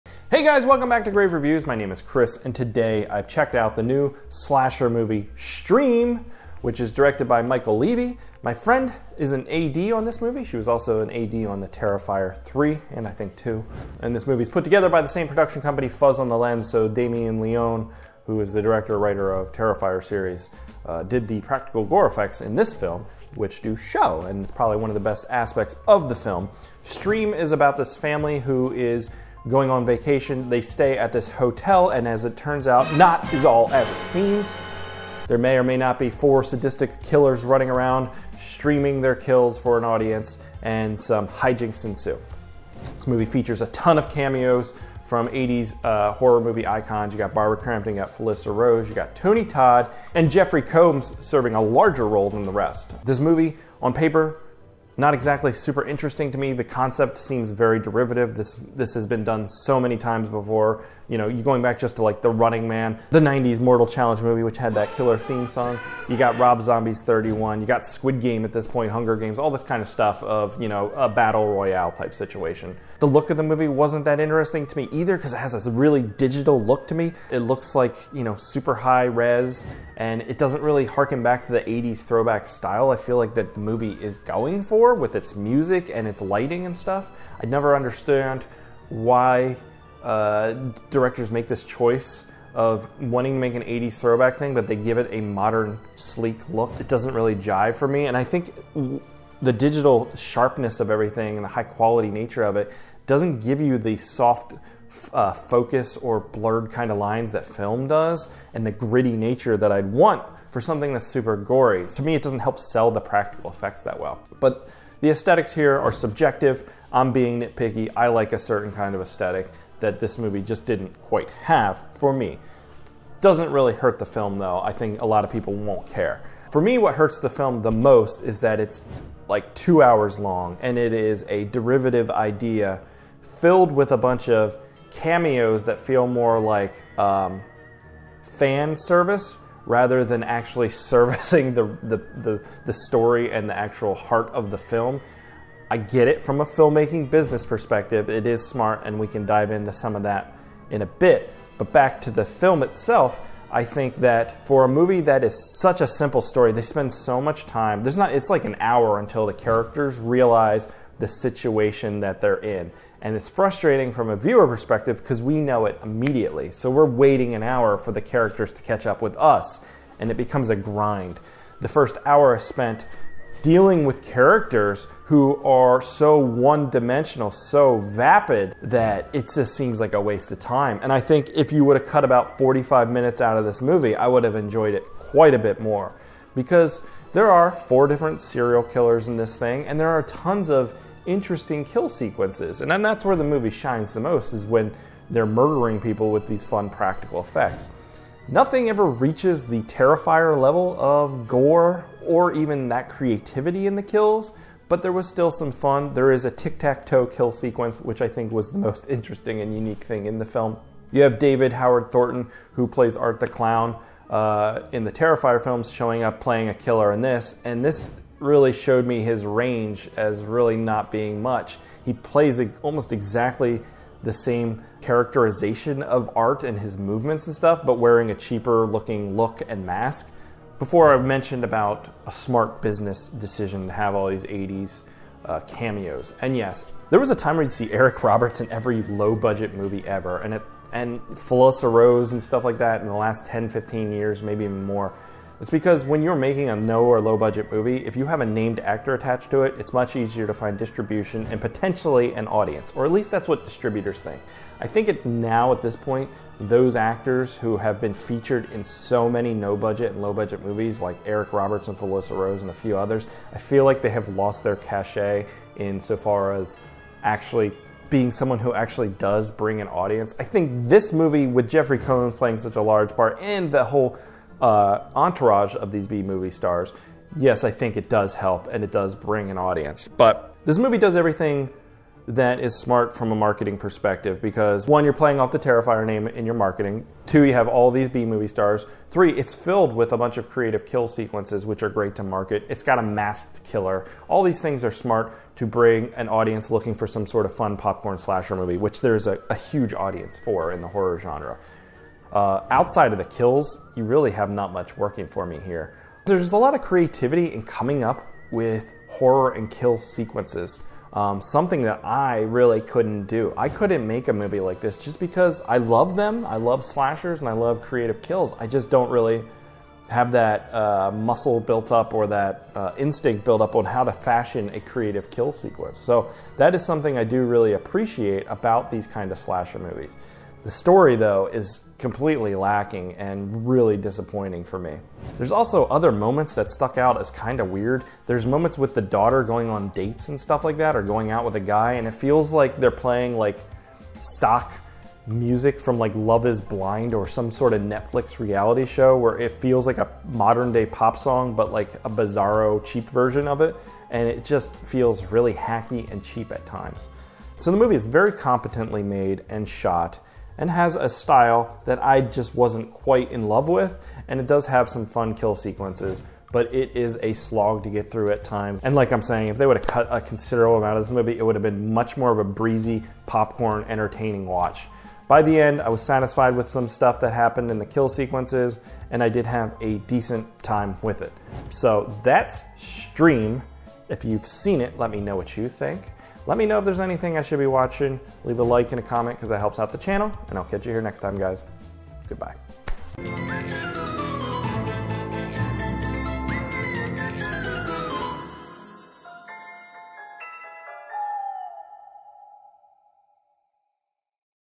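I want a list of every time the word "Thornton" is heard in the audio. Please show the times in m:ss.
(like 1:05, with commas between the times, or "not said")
3:31.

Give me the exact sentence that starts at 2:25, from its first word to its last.
I get it from a filmmaking business perspective.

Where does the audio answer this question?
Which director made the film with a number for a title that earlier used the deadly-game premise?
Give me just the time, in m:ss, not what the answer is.
1:06.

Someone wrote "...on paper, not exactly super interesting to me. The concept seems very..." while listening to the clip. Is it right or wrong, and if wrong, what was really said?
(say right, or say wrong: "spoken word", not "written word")
right.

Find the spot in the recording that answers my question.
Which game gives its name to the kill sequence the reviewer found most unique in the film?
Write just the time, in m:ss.
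3:26.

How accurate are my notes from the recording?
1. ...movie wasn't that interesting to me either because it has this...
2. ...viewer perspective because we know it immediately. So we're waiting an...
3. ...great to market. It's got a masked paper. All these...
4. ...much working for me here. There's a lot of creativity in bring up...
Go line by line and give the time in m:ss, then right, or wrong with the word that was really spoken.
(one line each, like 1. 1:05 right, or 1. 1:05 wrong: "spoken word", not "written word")
1. 1:13 right
2. 2:44 right
3. 4:51 wrong: "killer", not "paper"
4. 5:04 wrong: "coming", not "bring".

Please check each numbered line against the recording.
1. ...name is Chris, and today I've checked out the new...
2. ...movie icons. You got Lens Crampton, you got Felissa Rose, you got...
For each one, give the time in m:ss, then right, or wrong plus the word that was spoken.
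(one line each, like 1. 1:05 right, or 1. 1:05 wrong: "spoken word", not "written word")
1. 0:01 right
2. 0:46 wrong: "Barbara", not "Lens".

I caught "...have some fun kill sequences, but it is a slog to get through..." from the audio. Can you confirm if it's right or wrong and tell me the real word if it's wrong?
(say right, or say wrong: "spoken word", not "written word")
right.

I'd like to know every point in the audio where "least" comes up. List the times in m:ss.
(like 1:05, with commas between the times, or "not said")
4:12.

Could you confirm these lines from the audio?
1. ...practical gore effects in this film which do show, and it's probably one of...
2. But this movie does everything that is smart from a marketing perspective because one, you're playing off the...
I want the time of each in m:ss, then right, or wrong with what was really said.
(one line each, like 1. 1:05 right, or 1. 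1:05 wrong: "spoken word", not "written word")
1. 0:21 right
2. 4:39 right.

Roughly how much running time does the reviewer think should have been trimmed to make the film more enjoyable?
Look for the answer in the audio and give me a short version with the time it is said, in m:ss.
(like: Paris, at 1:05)
45 minutes, at 3:02.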